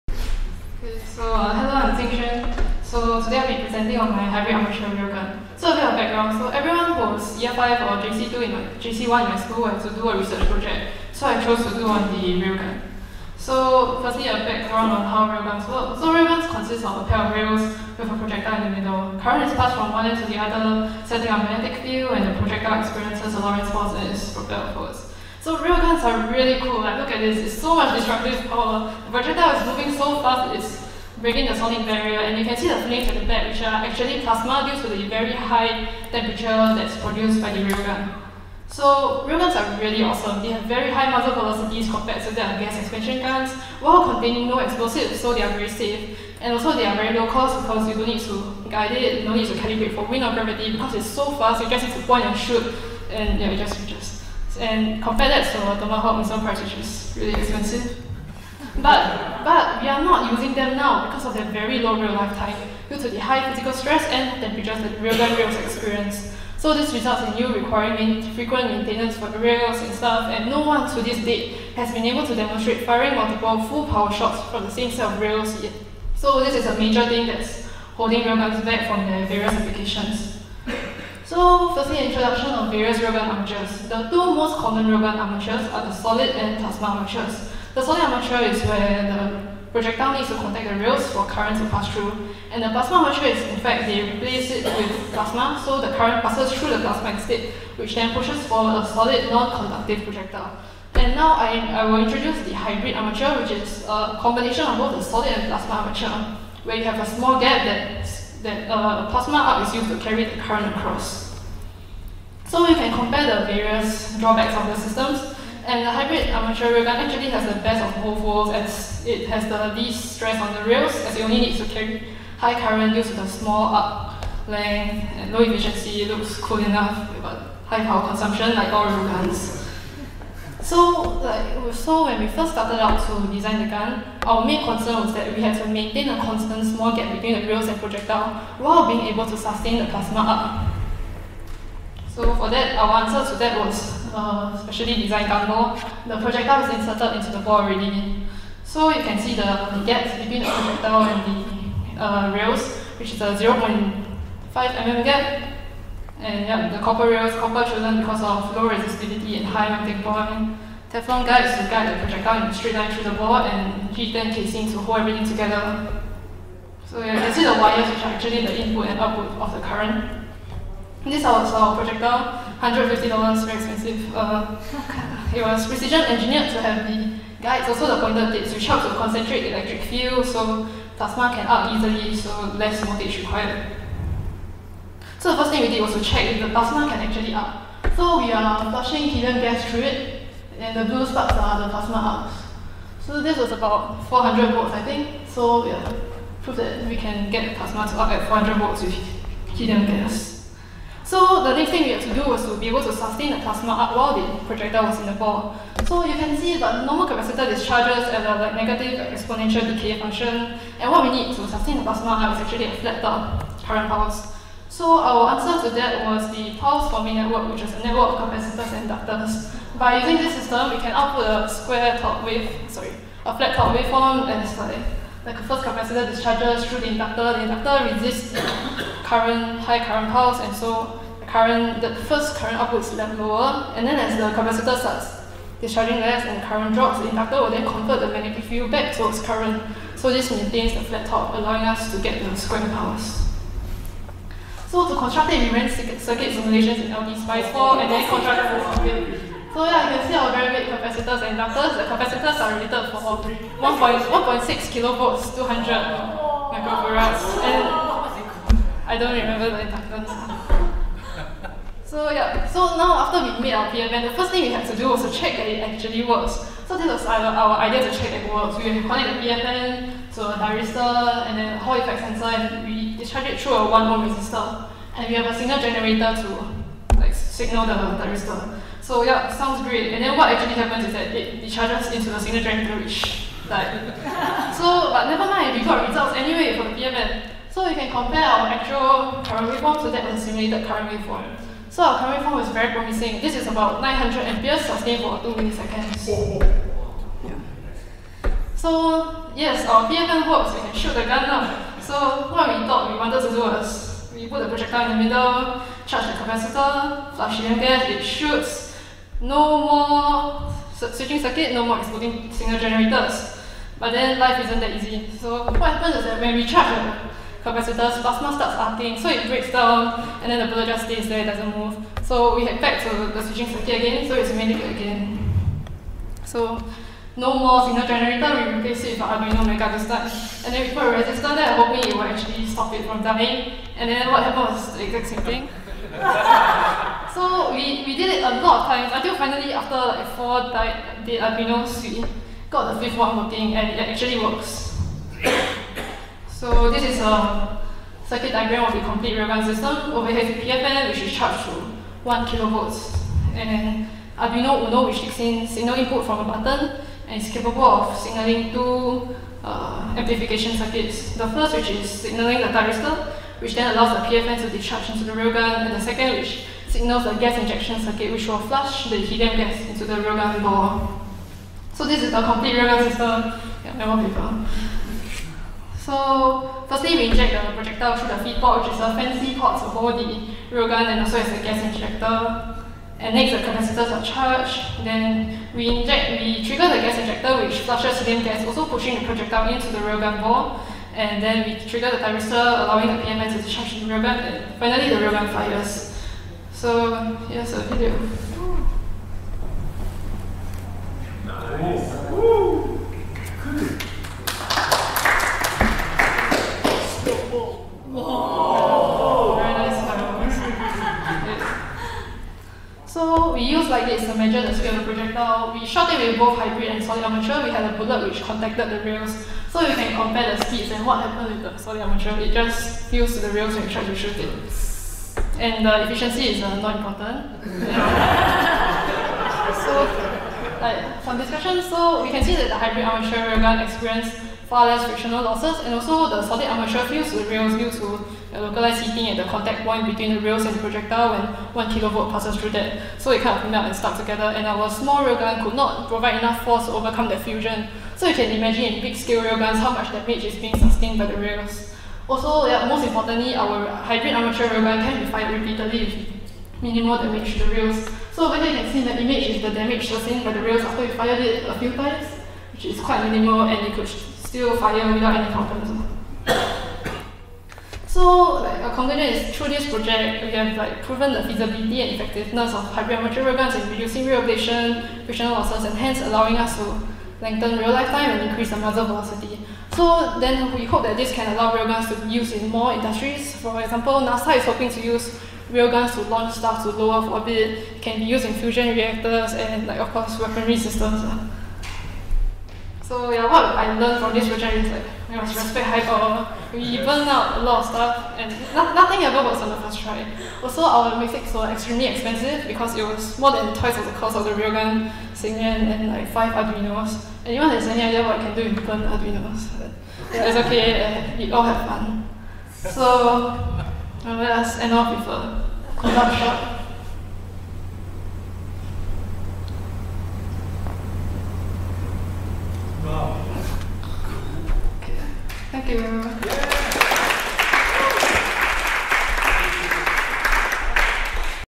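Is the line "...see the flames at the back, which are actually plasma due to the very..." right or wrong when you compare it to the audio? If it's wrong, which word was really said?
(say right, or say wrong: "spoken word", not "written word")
right.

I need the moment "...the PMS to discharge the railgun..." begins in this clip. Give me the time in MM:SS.
06:32.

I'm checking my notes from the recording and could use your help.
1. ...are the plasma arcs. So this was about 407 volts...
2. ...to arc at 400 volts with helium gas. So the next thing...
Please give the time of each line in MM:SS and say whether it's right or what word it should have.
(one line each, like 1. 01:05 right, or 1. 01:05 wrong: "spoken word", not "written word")
1. 03:11 wrong: "400", not "407"
2. 03:17 right.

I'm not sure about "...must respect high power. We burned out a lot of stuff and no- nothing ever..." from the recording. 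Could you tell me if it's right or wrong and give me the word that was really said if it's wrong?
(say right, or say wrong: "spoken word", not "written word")
right.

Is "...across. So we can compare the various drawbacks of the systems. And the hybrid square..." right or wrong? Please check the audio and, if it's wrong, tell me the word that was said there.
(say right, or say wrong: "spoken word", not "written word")
wrong: "armature", not "square".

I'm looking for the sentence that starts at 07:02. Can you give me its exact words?
It just used to the rails when you tried to shoot it and the efficiency is uh, not important.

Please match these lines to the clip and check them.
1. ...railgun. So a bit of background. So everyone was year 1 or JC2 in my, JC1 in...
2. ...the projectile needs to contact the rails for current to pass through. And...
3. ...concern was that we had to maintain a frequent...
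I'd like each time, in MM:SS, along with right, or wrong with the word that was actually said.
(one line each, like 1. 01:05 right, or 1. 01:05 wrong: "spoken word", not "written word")
1. 00:04 wrong: "5", not "1"
2. 01:29 right
3. 02:14 wrong: "constant", not "frequent".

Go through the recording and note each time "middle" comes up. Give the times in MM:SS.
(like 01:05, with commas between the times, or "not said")
00:18, 05:05.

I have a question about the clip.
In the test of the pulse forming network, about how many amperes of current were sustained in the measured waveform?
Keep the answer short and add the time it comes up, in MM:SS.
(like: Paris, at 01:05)
900 amperes, at 04:53.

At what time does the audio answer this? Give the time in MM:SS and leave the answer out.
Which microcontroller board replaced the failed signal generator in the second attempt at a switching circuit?
05:28.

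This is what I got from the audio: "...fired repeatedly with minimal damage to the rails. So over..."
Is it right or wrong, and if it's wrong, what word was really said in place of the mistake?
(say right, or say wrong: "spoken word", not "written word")
right.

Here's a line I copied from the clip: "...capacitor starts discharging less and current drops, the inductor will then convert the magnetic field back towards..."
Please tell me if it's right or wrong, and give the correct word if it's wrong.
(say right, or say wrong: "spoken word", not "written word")
right.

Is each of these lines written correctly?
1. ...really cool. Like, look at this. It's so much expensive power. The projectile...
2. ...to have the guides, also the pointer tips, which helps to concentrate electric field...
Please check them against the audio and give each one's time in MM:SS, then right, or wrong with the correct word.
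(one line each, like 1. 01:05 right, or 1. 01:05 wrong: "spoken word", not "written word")
1. 00:26 wrong: "destructive", not "expensive"
2. 02:56 right.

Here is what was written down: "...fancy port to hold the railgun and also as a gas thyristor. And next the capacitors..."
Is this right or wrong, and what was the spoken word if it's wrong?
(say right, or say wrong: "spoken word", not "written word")
wrong: "injector", not "thyristor".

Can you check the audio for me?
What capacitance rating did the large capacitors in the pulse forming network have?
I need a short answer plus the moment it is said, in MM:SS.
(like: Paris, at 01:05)
200 microfarads, at 04:15.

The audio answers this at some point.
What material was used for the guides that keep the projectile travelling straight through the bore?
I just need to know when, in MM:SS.
02:40.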